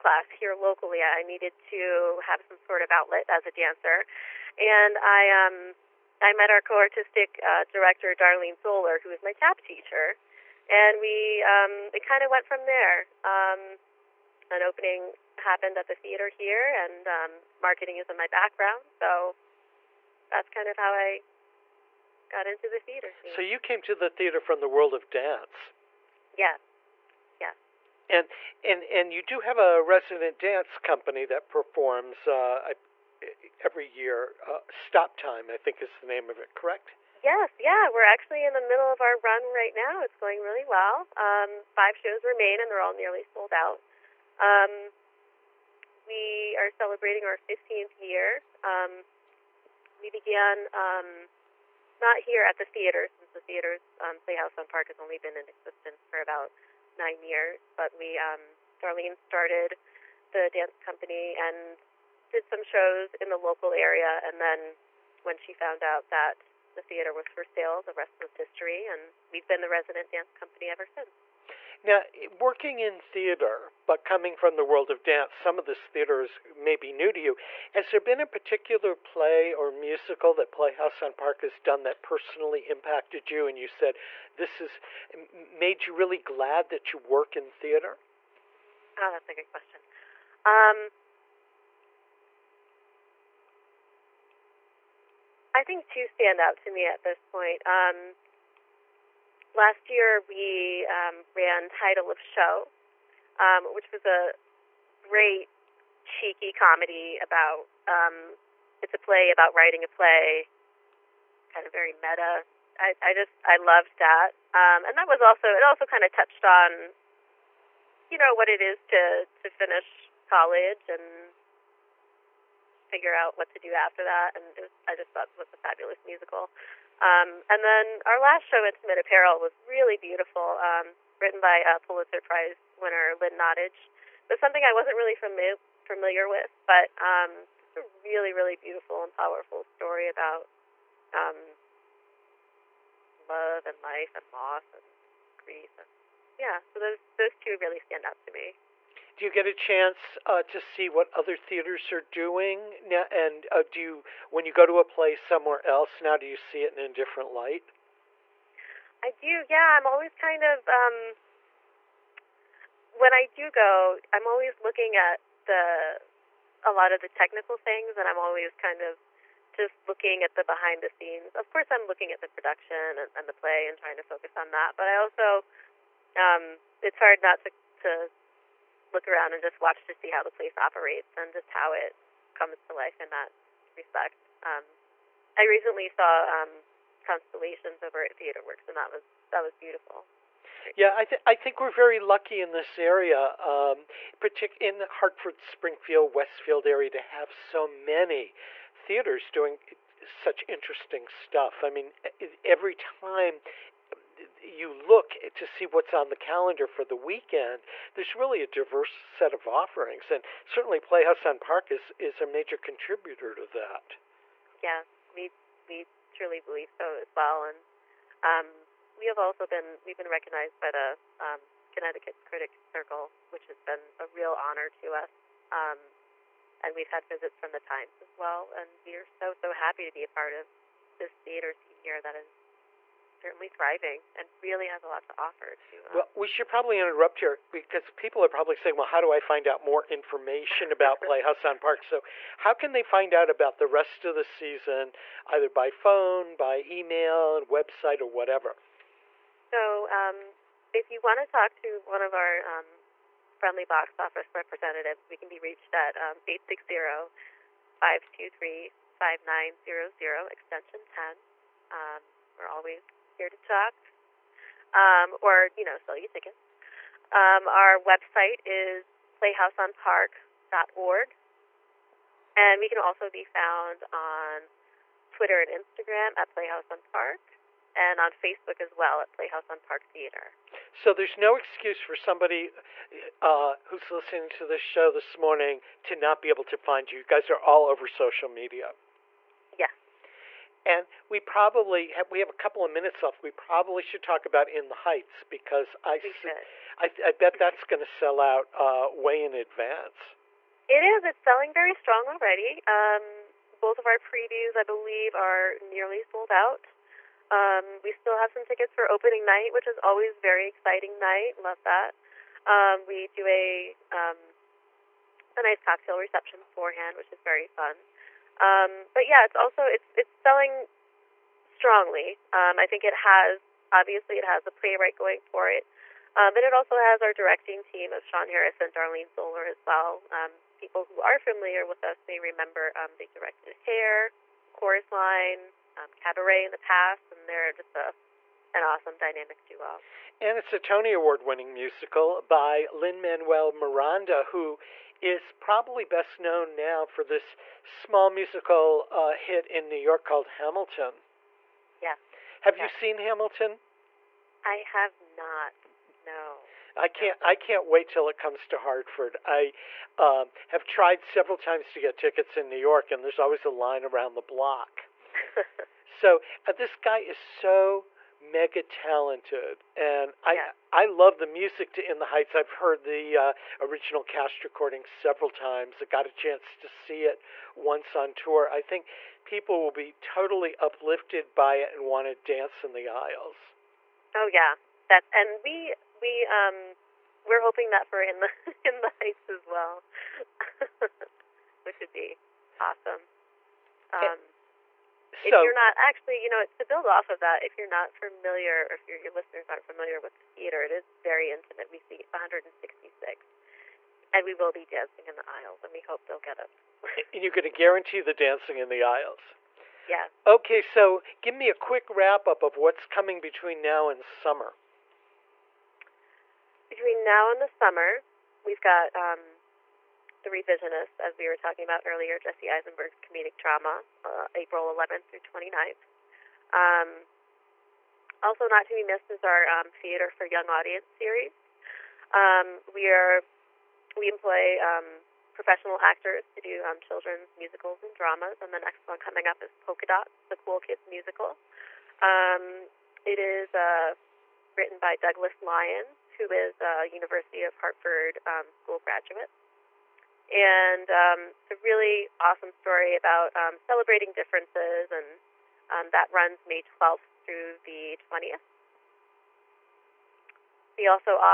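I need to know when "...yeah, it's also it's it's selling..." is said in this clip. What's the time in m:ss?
5:19.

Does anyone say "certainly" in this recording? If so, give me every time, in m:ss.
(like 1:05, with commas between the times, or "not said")
3:30, 3:53.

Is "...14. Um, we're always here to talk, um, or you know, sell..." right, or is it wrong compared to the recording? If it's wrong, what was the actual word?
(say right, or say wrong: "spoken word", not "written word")
wrong: "10", not "14".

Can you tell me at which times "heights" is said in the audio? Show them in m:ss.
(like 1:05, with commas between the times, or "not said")
4:54, 6:12, 6:29.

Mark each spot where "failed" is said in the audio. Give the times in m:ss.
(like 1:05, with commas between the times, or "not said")
not said.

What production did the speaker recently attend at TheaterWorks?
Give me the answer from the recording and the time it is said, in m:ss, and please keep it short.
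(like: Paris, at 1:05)
Constellations, at 3:07.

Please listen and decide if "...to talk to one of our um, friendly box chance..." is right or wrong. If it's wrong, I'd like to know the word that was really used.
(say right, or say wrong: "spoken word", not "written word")
wrong: "office", not "chance".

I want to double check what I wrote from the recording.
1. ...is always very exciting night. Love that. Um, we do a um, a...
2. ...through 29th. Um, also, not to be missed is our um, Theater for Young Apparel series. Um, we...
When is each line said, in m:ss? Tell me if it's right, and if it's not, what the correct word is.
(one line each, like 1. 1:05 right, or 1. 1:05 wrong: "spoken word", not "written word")
1. 5:09 right
2. 7:05 wrong: "Audience", not "Apparel".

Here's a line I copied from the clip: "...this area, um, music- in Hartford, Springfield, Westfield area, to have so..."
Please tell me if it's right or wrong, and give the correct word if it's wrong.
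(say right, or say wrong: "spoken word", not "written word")
wrong: "partic", not "music".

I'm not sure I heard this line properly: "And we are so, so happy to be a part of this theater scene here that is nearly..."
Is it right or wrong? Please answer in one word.
wrong.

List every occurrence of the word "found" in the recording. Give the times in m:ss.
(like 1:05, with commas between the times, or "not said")
1:05, 4:33.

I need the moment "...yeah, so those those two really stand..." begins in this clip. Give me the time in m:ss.
2:26.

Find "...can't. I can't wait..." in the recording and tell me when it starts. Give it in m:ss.
5:56.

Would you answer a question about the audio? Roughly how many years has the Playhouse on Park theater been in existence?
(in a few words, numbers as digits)
9.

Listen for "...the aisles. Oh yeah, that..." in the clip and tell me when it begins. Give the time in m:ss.
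6:22.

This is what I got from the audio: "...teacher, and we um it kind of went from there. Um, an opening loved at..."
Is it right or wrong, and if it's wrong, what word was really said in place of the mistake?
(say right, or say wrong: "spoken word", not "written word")
wrong: "happened", not "loved".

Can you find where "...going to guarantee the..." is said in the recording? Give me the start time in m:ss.
6:47.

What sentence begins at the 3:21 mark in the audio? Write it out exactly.
I mean, every time you look to see what's on the calendar for the weekend, there's really a diverse set of offerings.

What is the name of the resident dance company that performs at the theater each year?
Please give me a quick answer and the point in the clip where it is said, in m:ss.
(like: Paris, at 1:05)
Stop Time, at 0:34.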